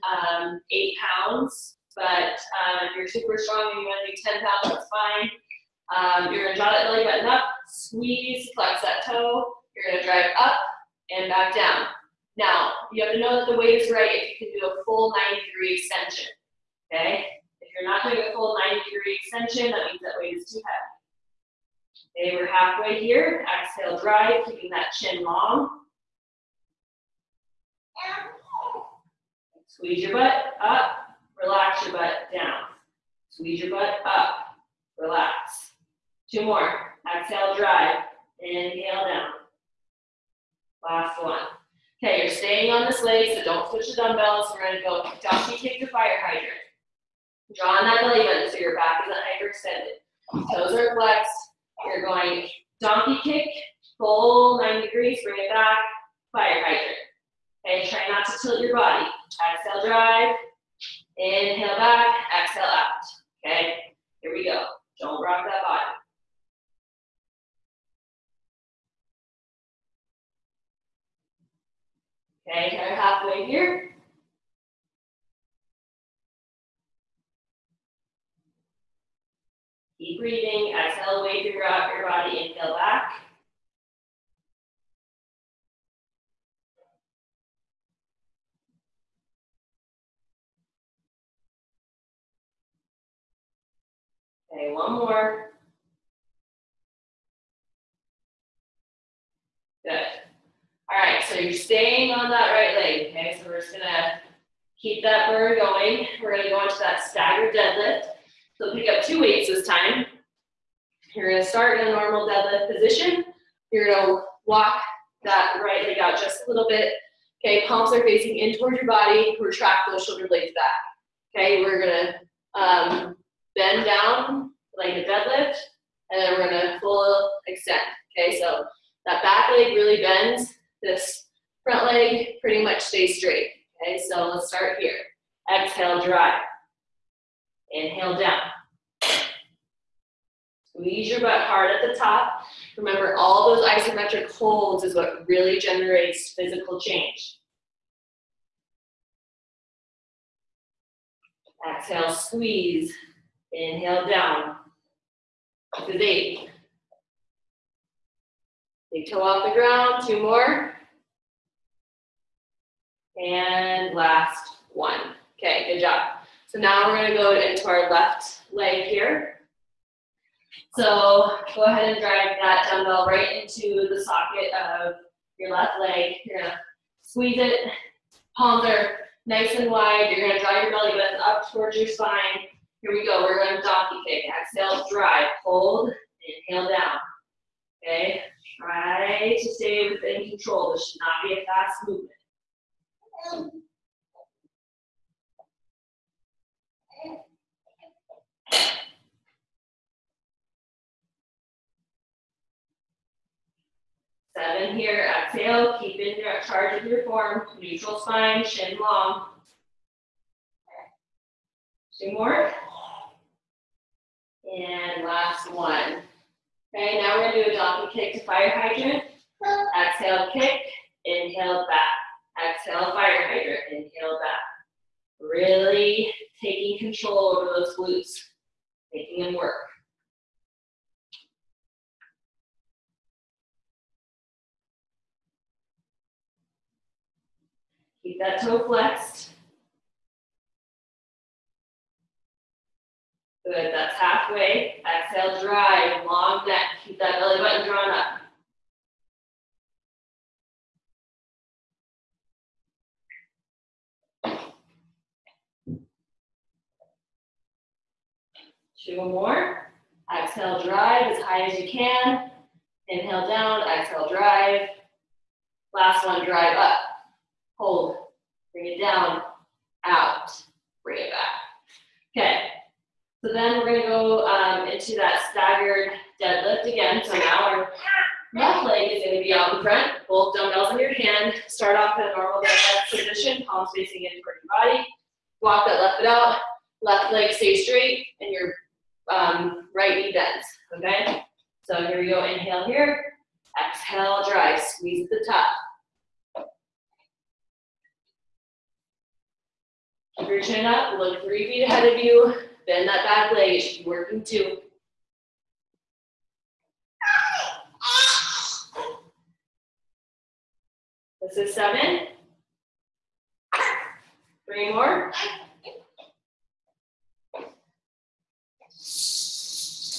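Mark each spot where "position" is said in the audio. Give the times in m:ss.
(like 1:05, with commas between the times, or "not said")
1:52, 4:42.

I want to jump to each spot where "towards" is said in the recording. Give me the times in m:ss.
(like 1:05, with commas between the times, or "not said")
1:58, 3:01, 4:44.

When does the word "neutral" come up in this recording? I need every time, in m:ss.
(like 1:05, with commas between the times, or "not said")
3:27.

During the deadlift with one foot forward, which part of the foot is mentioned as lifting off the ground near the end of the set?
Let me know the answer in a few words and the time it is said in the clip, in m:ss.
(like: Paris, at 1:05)
Big toe, at 2:38.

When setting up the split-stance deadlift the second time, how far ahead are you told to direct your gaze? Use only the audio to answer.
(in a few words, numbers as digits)
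3 feet.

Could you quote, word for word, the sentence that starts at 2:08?
Okay, so that back leg really bends this front leg pretty much stays straight.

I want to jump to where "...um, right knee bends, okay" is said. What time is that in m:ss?
4:49.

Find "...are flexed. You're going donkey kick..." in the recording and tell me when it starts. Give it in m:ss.
0:50.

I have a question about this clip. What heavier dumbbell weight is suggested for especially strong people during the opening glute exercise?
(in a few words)
10 pounds.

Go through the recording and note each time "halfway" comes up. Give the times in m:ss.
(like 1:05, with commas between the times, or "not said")
0:22, 1:12, 4:03.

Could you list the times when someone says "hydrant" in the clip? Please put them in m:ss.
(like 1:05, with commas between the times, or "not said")
0:46, 0:56, 3:38, 3:43.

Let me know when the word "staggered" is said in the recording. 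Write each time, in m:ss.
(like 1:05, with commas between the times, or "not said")
1:47, 4:35.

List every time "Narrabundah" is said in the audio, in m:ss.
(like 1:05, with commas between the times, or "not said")
not said.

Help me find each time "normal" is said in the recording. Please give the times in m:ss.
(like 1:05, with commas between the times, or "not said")
1:51, 4:42.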